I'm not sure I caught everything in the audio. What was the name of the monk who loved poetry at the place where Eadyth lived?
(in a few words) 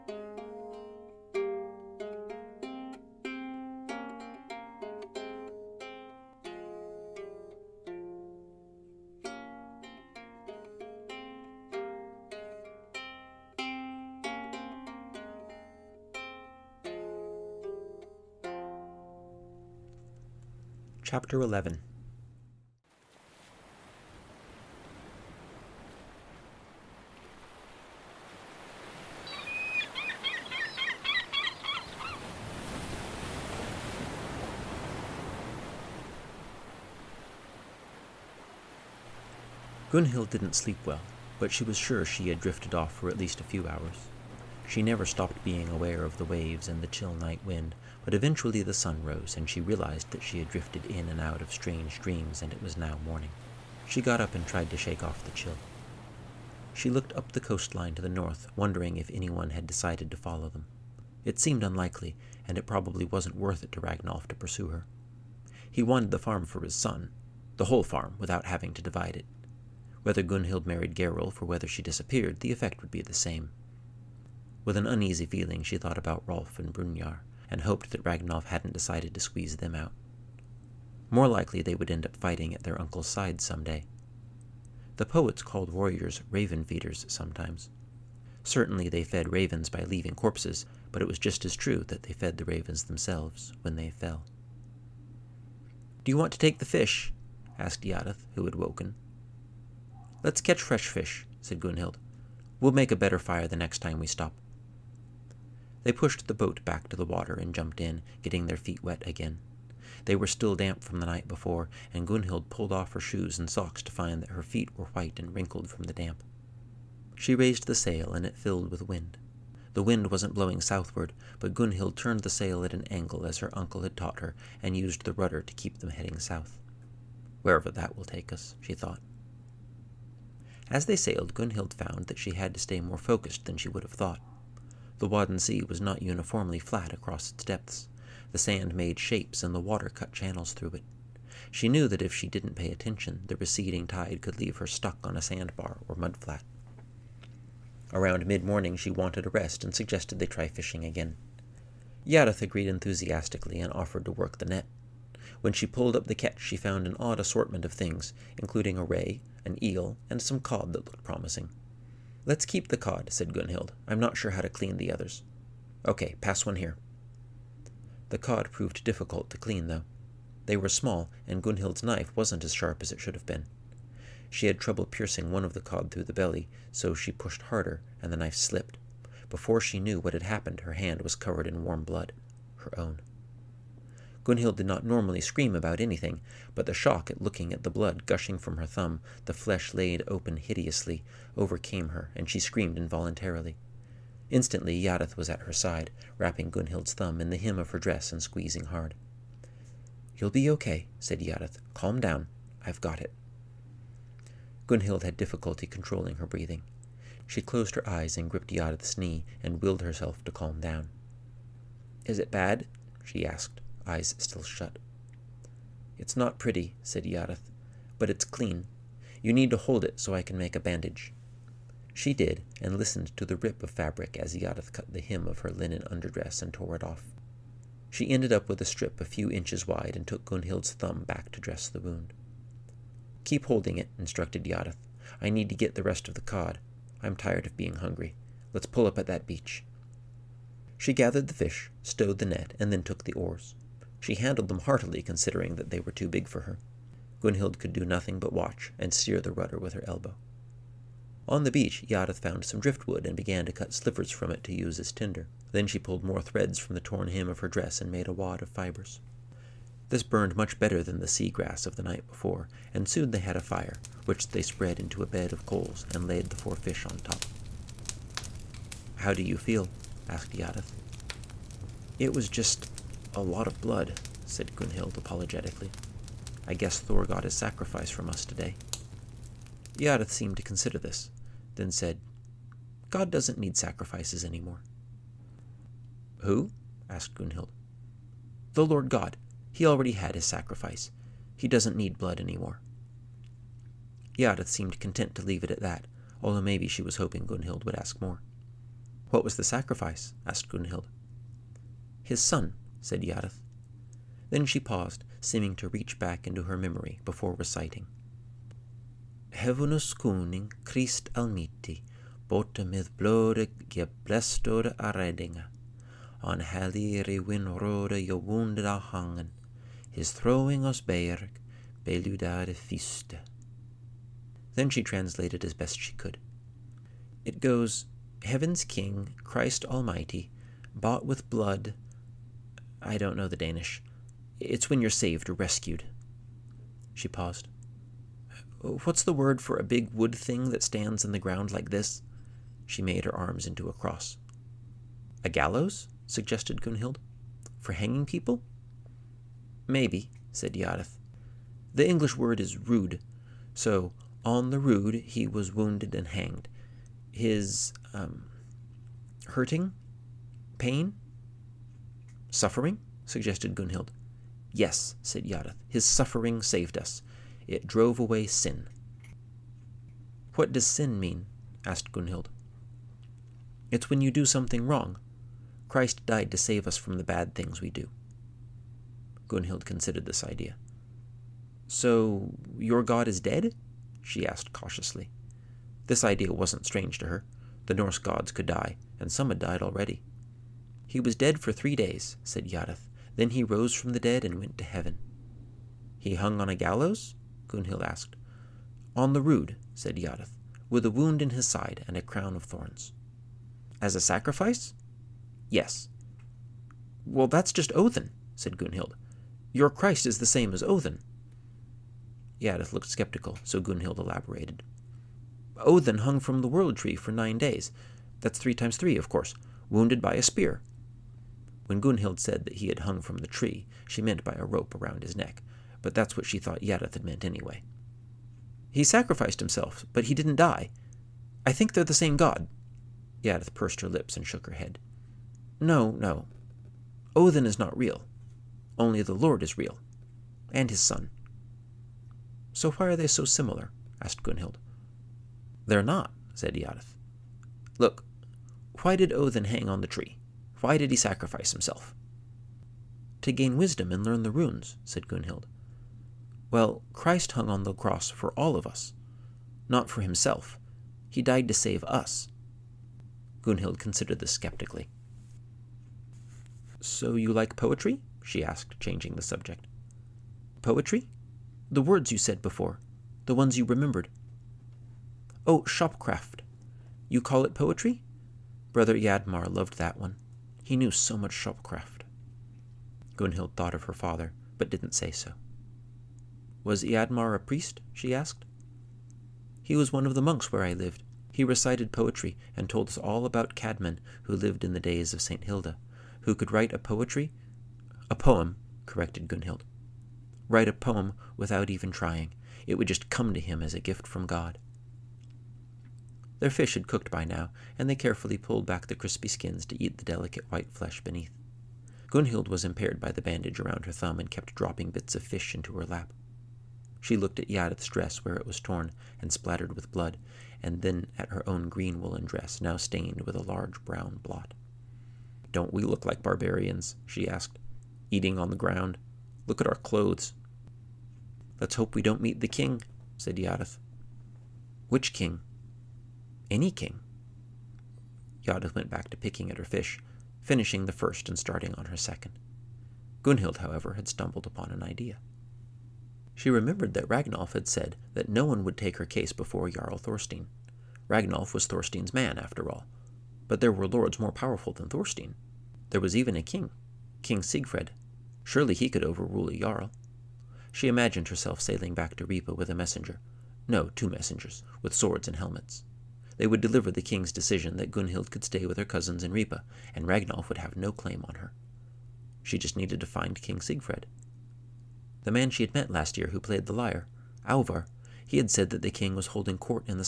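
Brother Eadmar.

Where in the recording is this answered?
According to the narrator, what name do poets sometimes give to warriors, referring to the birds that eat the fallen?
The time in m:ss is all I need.
1:26.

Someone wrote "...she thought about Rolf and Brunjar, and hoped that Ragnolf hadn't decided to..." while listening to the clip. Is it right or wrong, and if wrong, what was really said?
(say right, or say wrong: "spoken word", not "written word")
right.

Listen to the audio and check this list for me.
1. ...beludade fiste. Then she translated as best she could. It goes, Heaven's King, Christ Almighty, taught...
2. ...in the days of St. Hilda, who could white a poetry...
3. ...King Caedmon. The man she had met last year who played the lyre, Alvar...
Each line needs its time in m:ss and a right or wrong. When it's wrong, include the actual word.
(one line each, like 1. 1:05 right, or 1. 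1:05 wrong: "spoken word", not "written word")
1. 5:21 wrong: "bought", not "taught"
2. 8:14 wrong: "write", not "white"
3. 9:33 wrong: "Siegfried", not "Caedmon".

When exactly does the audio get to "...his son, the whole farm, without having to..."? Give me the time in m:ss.
1:06.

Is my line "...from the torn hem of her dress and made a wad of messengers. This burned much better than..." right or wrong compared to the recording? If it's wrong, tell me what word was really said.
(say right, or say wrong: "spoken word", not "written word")
wrong: "fibers", not "messengers".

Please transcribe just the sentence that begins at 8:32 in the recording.
Gunnhild was impaired by the bandage around her thumb and kept dropping bits of fish into her lap.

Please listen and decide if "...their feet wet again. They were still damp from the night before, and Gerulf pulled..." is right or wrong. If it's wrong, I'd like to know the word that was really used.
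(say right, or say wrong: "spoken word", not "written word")
wrong: "Gunnhild", not "Gerulf".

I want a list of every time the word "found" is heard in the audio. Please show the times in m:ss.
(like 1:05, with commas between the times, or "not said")
2:11, 2:36, 4:12.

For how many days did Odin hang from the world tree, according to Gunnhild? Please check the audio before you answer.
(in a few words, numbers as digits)
9.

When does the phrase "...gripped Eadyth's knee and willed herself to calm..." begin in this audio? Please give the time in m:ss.
3:28.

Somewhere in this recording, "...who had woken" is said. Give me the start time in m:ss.
1:38.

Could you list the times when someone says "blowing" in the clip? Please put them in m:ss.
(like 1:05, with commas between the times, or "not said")
2:00.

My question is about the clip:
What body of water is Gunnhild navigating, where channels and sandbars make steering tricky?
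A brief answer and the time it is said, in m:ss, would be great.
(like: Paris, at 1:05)
Wadden Sea, at 2:15.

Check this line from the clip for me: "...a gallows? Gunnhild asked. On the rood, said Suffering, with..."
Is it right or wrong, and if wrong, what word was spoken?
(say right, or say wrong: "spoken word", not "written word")
wrong: "Eadyth", not "Suffering".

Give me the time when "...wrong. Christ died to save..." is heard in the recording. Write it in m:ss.
6:14.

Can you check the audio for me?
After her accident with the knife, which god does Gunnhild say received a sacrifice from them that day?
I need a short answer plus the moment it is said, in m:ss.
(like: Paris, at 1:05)
Thor, at 4:36.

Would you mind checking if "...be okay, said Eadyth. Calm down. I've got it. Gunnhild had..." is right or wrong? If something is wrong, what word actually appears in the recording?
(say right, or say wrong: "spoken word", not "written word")
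right.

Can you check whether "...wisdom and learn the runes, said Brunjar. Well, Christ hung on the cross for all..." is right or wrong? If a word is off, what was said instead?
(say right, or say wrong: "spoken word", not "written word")
wrong: "Gunnhild", not "Brunjar".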